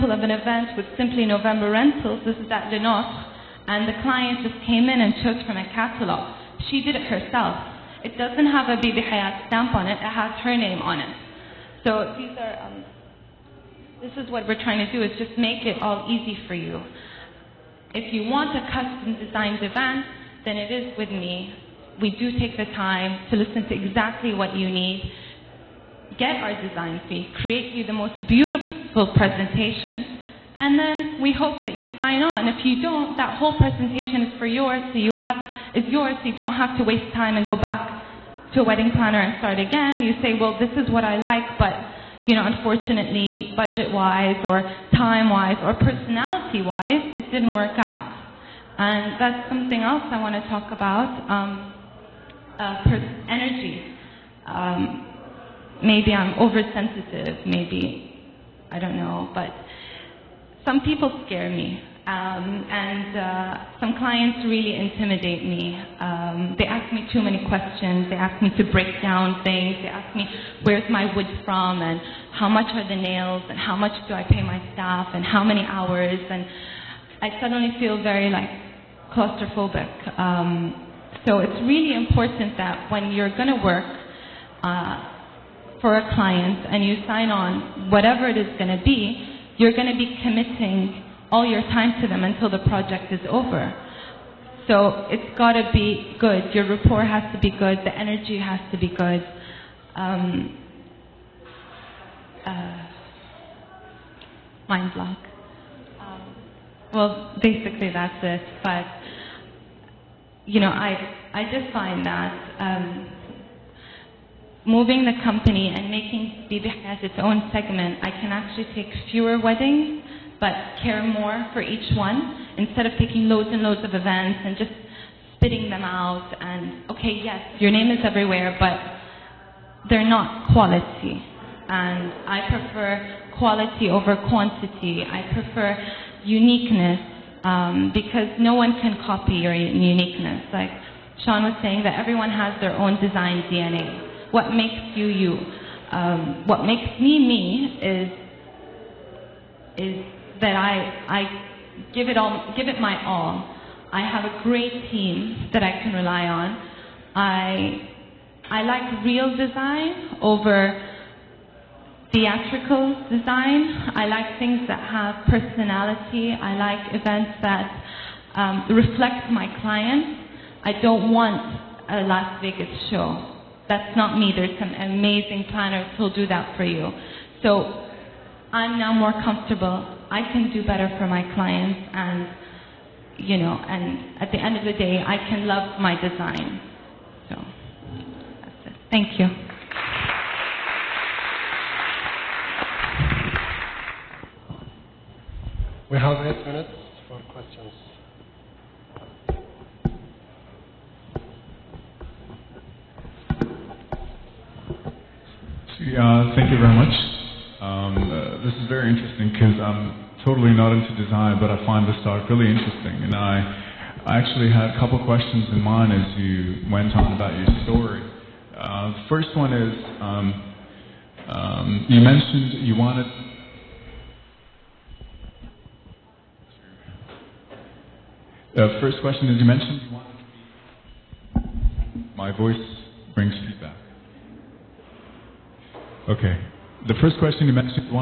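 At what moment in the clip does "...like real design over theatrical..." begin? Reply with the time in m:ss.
2:38.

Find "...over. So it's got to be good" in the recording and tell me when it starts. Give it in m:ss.
1:33.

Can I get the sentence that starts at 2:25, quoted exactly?
Um, what makes me me is is that I, I give, it all, give it my all.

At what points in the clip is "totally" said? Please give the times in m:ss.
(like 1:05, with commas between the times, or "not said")
3:30.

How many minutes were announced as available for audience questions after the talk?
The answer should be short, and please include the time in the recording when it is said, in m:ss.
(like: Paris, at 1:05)
8, at 3:16.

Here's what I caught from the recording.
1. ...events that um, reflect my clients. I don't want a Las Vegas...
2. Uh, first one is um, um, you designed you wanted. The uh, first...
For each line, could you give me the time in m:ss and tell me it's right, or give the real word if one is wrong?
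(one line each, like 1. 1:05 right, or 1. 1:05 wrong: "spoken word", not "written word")
1. 2:47 right
2. 3:38 wrong: "mentioned", not "designed".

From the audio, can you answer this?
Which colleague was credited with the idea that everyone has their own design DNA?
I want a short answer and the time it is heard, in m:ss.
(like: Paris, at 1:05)
Sean, at 2:21.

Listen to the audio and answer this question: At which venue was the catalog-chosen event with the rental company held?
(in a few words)
Le Notre.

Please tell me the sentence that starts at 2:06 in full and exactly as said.
And okay, yes, your name is everywhere, but they're not quality.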